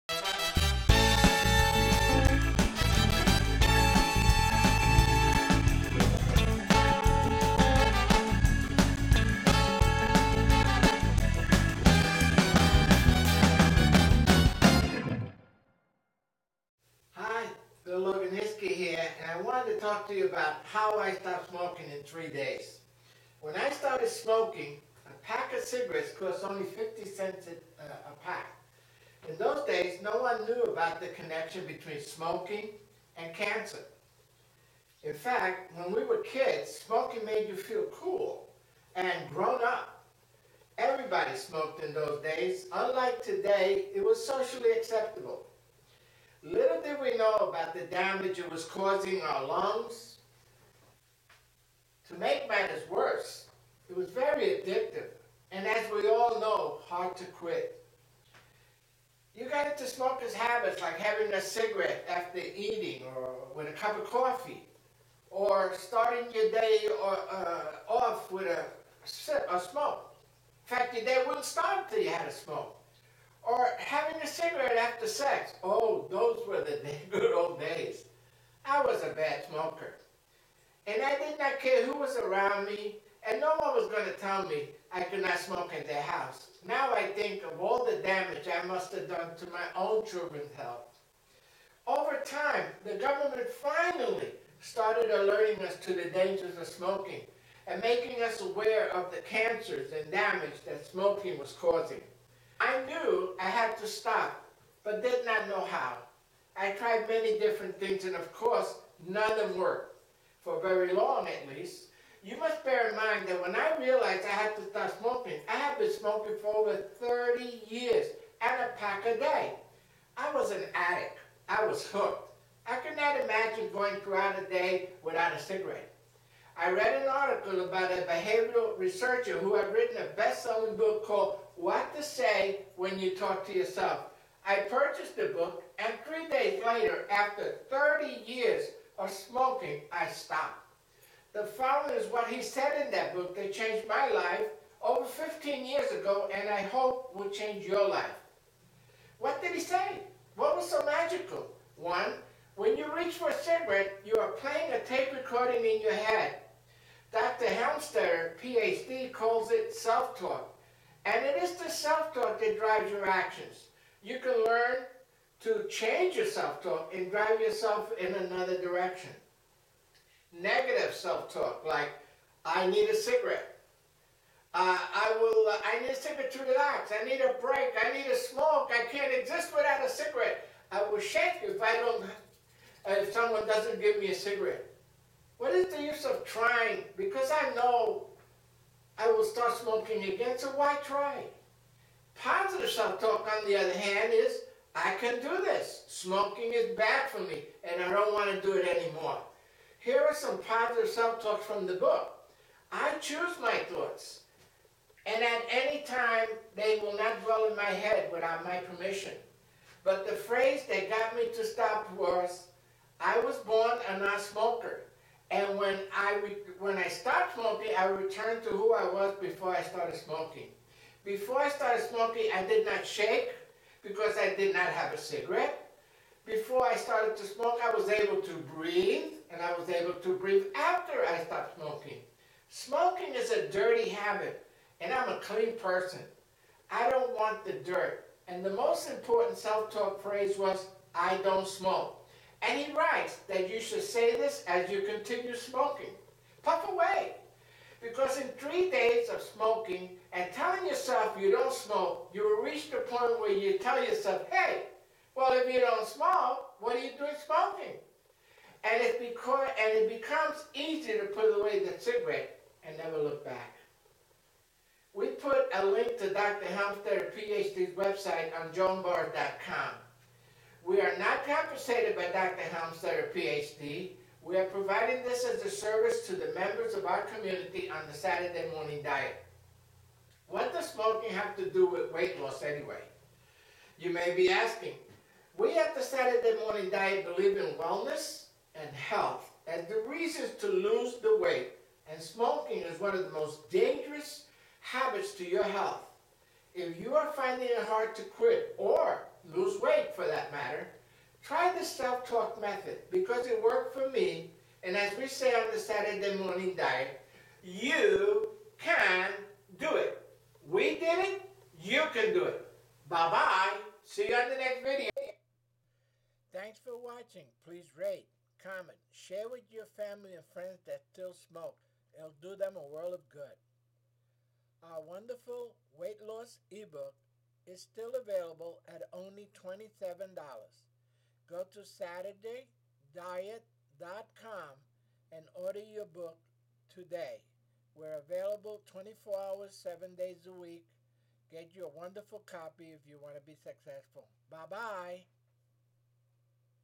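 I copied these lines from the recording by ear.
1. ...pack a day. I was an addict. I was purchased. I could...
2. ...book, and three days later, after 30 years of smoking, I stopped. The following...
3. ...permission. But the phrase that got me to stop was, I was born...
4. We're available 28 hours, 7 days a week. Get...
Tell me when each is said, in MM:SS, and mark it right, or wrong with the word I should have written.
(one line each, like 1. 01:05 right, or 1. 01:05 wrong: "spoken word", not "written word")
1. 01:58 wrong: "hooked", not "purchased"
2. 02:15 right
3. 03:28 right
4. 05:37 wrong: "24", not "28".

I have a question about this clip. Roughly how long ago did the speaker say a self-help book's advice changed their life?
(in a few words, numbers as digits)
over 15 years.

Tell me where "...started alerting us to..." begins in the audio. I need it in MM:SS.
01:34.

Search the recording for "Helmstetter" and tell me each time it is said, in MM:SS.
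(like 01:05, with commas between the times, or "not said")
02:37, 04:26, 04:32.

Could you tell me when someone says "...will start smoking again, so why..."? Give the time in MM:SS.
03:09.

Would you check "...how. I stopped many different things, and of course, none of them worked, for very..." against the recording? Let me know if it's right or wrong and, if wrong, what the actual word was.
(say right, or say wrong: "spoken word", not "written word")
wrong: "tried", not "stopped".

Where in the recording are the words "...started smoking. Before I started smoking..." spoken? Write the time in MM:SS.
03:39.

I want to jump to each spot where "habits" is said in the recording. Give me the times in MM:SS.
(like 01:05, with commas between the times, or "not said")
01:00, 03:53, 04:54.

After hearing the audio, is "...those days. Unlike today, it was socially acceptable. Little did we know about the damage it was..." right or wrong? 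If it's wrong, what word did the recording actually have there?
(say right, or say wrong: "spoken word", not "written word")
right.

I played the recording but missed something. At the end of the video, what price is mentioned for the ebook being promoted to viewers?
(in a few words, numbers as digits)
$27.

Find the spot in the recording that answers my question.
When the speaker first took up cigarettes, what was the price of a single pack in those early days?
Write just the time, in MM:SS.
00:26.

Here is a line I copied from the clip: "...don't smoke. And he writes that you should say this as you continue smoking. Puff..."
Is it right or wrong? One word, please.
right.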